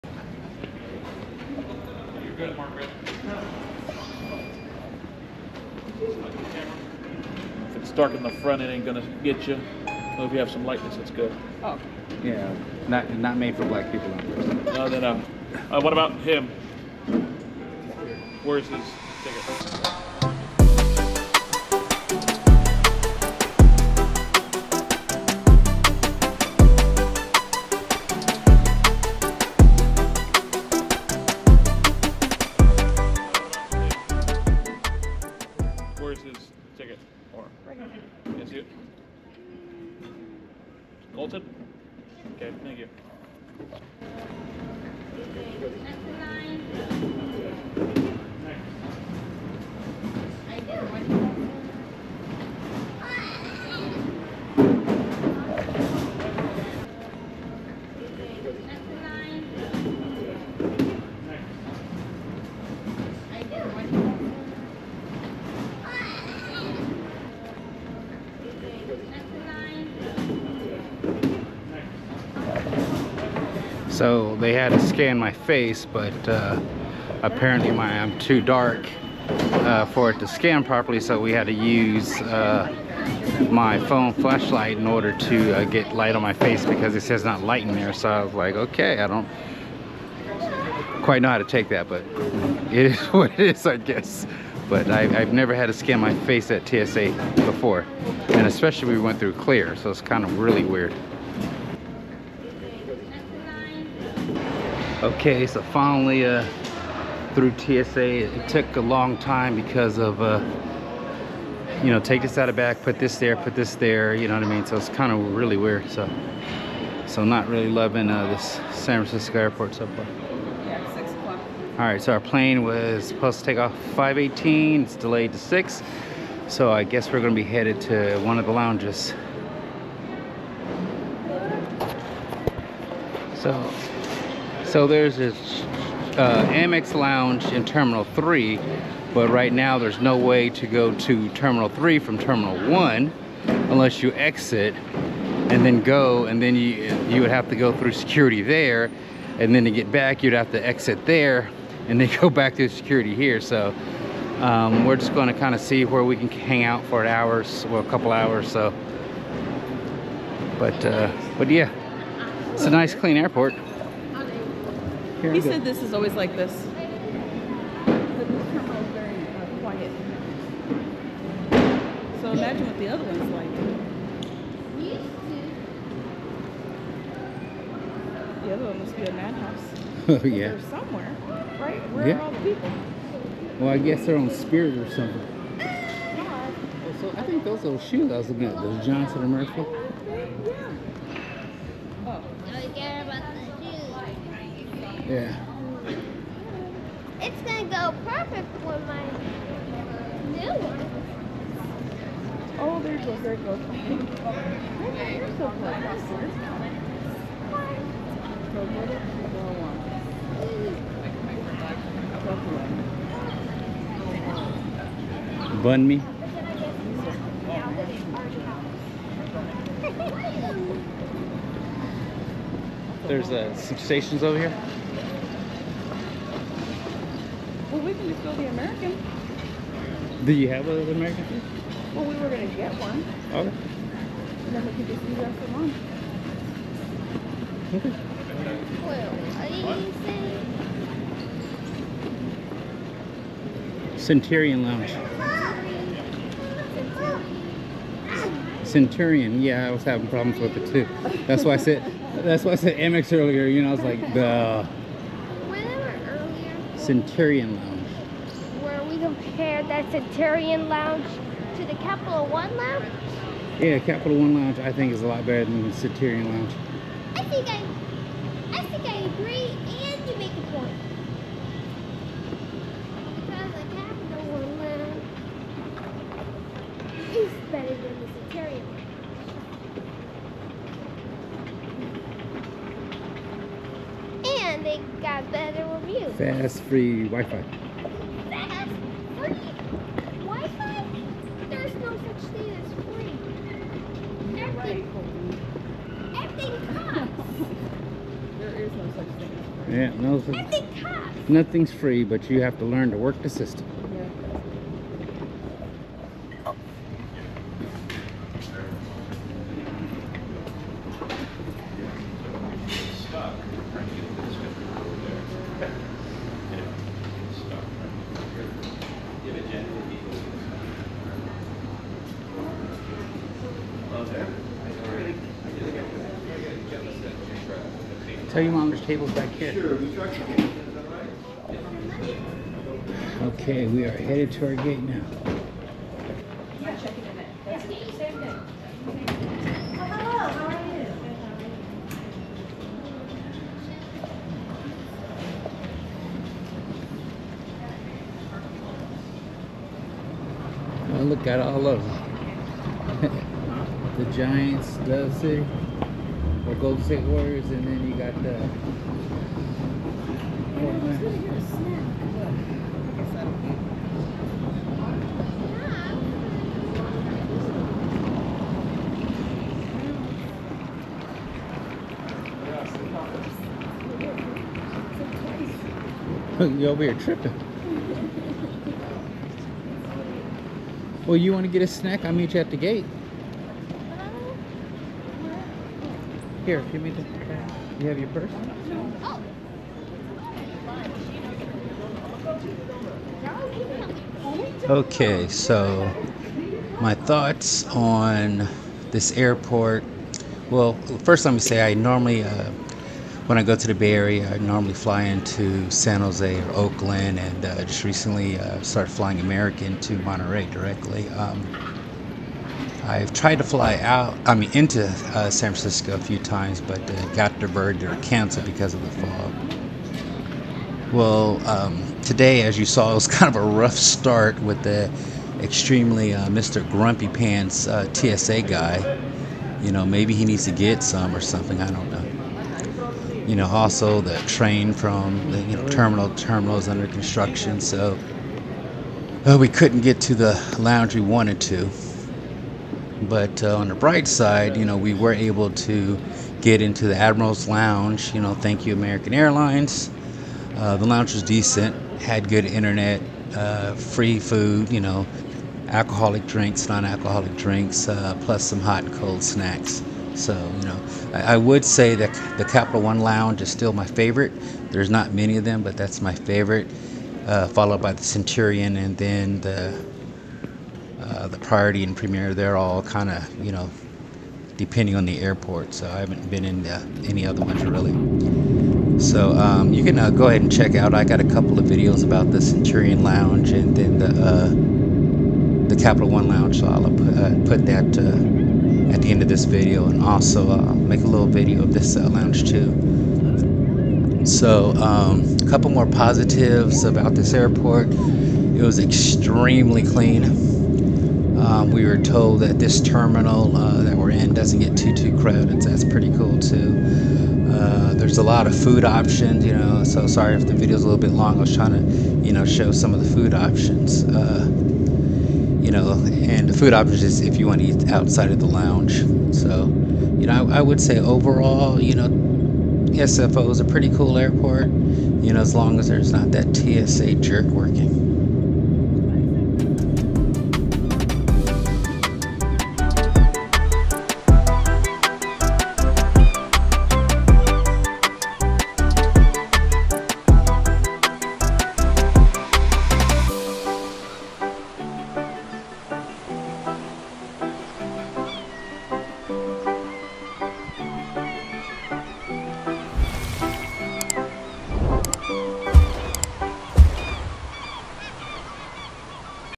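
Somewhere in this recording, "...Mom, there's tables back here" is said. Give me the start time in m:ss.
5:28.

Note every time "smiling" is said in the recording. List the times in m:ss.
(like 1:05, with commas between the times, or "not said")
not said.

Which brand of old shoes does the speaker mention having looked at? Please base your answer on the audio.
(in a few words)
Johnston and Murphy.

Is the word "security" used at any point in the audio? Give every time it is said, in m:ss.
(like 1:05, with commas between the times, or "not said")
2:27, 2:32.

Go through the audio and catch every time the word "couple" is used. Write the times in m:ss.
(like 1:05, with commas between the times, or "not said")
2:37, 8:01, 8:15.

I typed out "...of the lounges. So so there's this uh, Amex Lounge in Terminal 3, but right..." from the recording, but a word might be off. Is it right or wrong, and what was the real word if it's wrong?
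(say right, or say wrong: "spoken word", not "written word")
right.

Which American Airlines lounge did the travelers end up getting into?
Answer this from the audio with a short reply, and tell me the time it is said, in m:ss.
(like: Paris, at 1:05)
Admiral's Lounge, at 7:26.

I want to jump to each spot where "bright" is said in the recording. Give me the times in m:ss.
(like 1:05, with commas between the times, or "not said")
7:23.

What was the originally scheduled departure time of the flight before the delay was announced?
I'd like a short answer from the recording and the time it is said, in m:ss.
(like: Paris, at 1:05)
5:18, at 2:03.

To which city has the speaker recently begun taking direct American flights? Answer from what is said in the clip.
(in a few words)
Monterey.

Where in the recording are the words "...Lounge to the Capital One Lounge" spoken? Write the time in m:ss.
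4:20.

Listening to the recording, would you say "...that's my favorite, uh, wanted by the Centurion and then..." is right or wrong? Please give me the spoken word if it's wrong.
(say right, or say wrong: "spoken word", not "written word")
wrong: "followed", not "wanted".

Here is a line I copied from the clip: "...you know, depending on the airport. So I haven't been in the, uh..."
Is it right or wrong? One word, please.
right.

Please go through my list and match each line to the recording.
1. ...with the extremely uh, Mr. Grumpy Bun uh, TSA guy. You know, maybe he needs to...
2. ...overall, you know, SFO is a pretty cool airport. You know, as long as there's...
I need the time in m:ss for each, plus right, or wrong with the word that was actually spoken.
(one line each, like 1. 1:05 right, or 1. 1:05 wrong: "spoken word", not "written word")
1. 7:04 wrong: "Pants", not "Bun"
2. 8:40 right.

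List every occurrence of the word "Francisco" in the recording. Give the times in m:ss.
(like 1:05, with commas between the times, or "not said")
1:59, 6:55.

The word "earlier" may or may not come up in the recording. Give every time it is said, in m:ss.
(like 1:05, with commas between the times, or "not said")
4:13.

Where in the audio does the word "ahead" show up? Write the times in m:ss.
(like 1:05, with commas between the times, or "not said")
8:00.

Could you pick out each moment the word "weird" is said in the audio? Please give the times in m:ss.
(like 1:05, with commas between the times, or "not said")
1:40, 1:55.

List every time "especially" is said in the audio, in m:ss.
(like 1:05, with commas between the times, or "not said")
1:38.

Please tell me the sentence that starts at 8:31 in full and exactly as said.
I was trying to, you know, show some of the food options.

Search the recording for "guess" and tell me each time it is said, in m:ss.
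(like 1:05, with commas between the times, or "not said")
1:33, 2:06, 3:03.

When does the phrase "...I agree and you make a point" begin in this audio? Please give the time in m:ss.
4:28.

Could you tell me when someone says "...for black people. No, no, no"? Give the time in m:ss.
0:13.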